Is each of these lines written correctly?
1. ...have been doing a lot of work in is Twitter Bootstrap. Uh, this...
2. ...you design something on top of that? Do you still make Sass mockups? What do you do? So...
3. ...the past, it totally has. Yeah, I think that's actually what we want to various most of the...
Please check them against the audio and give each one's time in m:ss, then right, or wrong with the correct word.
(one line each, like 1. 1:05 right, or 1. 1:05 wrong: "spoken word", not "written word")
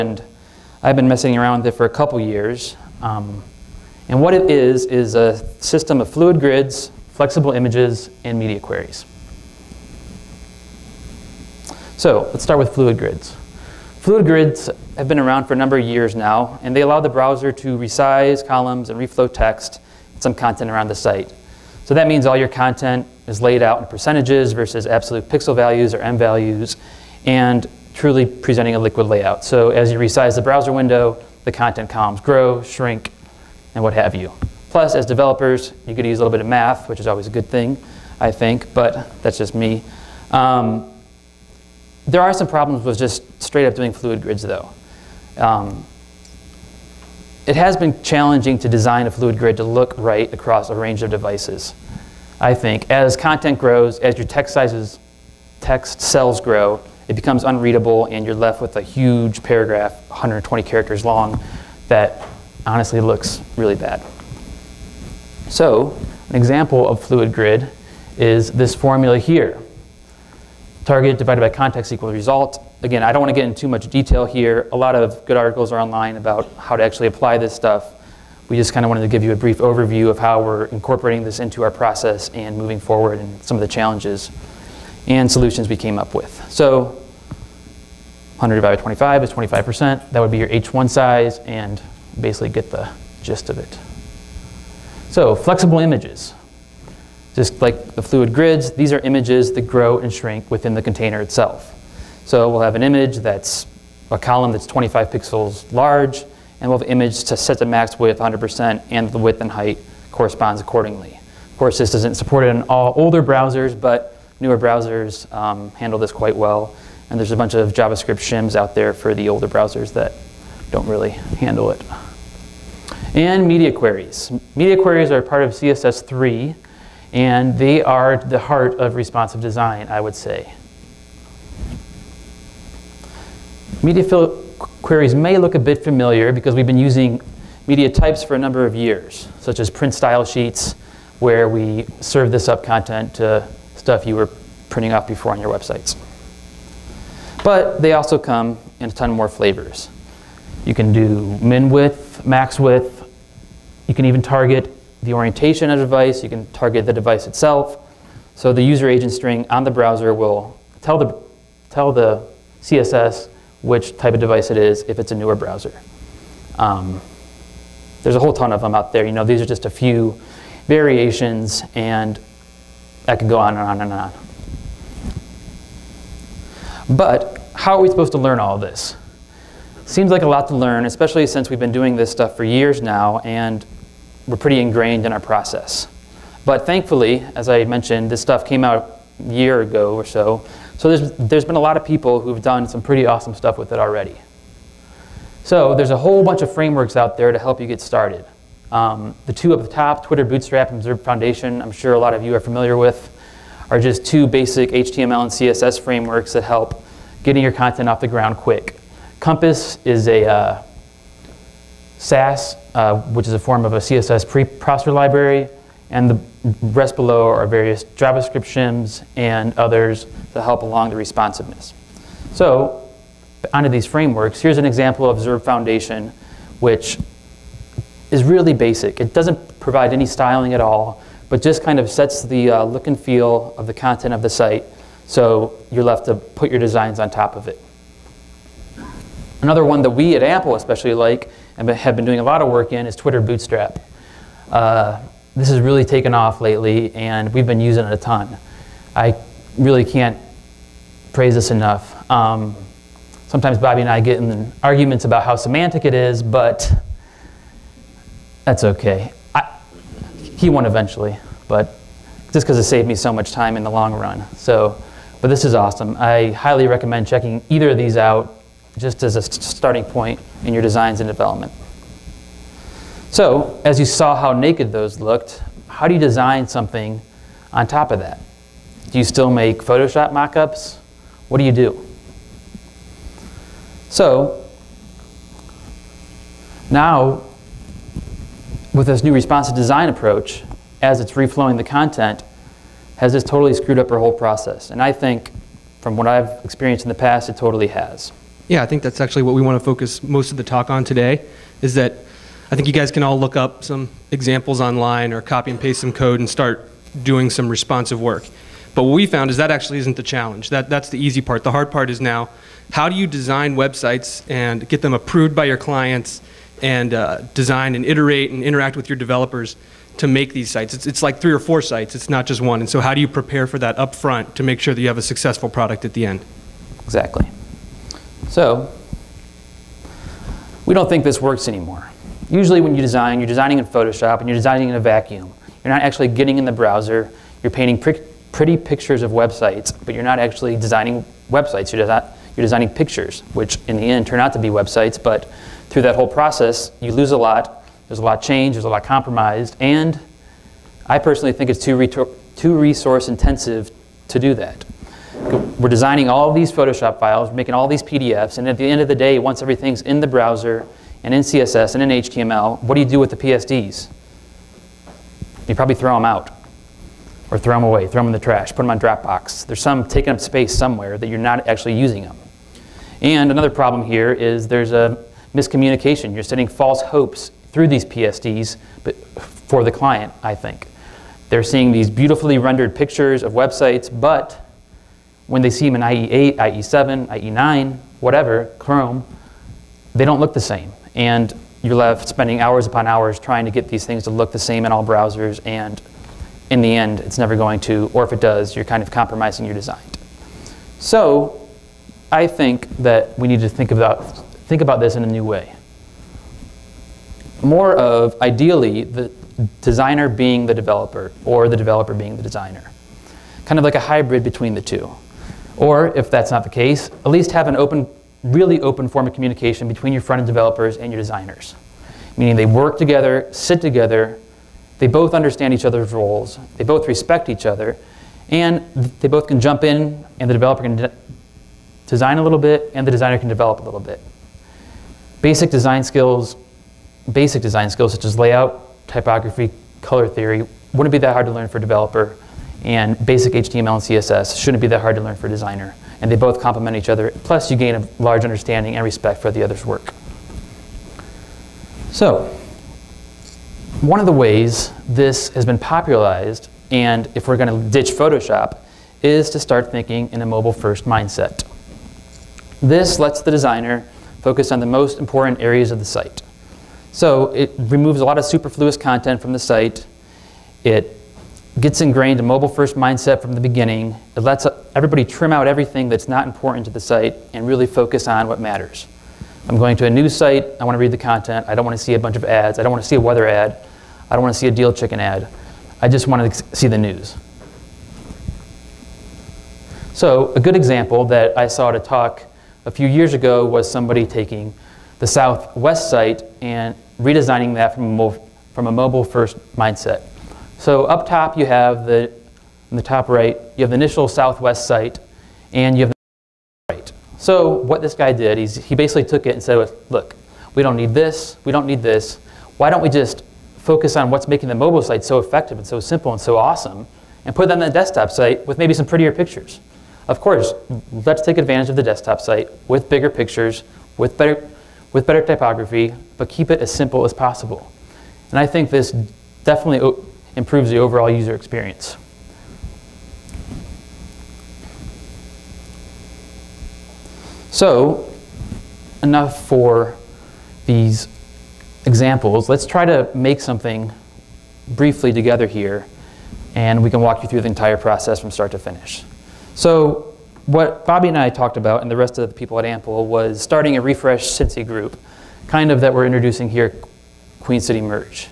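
1. 4:01 right
2. 4:35 wrong: "Photoshop", not "Sass"
3. 4:56 wrong: "focus", not "various".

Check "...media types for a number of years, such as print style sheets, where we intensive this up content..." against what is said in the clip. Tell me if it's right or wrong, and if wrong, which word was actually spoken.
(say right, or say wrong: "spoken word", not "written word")
wrong: "serve", not "intensive".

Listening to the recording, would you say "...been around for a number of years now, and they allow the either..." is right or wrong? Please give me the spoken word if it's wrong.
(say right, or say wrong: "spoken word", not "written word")
wrong: "browser", not "either".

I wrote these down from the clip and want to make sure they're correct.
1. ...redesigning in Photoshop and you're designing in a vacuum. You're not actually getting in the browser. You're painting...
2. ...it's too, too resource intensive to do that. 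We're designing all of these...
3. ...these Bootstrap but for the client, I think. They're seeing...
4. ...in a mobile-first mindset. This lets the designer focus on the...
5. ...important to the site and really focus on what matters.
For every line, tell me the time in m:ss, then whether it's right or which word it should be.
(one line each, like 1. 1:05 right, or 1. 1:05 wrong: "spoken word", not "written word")
1. 5:33 wrong: "designing", not "redesigning"
2. 5:51 right
3. 6:17 wrong: "PSDs", not "Bootstrap"
4. 7:40 right
5. 7:56 right.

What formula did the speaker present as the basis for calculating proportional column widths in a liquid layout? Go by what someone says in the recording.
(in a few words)
target divided by context equals result.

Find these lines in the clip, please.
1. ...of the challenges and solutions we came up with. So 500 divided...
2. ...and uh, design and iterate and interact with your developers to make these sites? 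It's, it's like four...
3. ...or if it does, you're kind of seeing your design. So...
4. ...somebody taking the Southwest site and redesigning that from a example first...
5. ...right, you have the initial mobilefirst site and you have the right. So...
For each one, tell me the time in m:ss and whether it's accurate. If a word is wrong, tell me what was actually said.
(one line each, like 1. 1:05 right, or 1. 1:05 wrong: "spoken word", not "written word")
1. 1:23 wrong: "100", not "500"
2. 5:16 wrong: "three", not "four"
3. 6:37 wrong: "compromising", not "seeing"
4. 8:13 wrong: "mobile", not "example"
5. 8:23 wrong: "southwest", not "mobilefirst".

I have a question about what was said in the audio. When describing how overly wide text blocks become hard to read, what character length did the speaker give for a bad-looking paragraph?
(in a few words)
120.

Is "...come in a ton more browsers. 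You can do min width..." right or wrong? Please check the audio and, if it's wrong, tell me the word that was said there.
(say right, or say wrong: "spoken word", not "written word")
wrong: "flavors", not "browsers".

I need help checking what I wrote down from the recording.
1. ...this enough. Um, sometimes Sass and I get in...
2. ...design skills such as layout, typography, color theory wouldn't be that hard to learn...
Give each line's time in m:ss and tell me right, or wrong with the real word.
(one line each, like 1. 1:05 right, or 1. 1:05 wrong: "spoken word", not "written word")
1. 4:11 wrong: "Bobby", not "Sass"
2. 7:17 right.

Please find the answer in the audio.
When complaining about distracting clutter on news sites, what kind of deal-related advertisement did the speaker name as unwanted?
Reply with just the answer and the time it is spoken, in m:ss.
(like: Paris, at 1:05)
deal chicken, at 8:04.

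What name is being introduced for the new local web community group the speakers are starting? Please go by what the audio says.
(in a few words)
Queen City Merge.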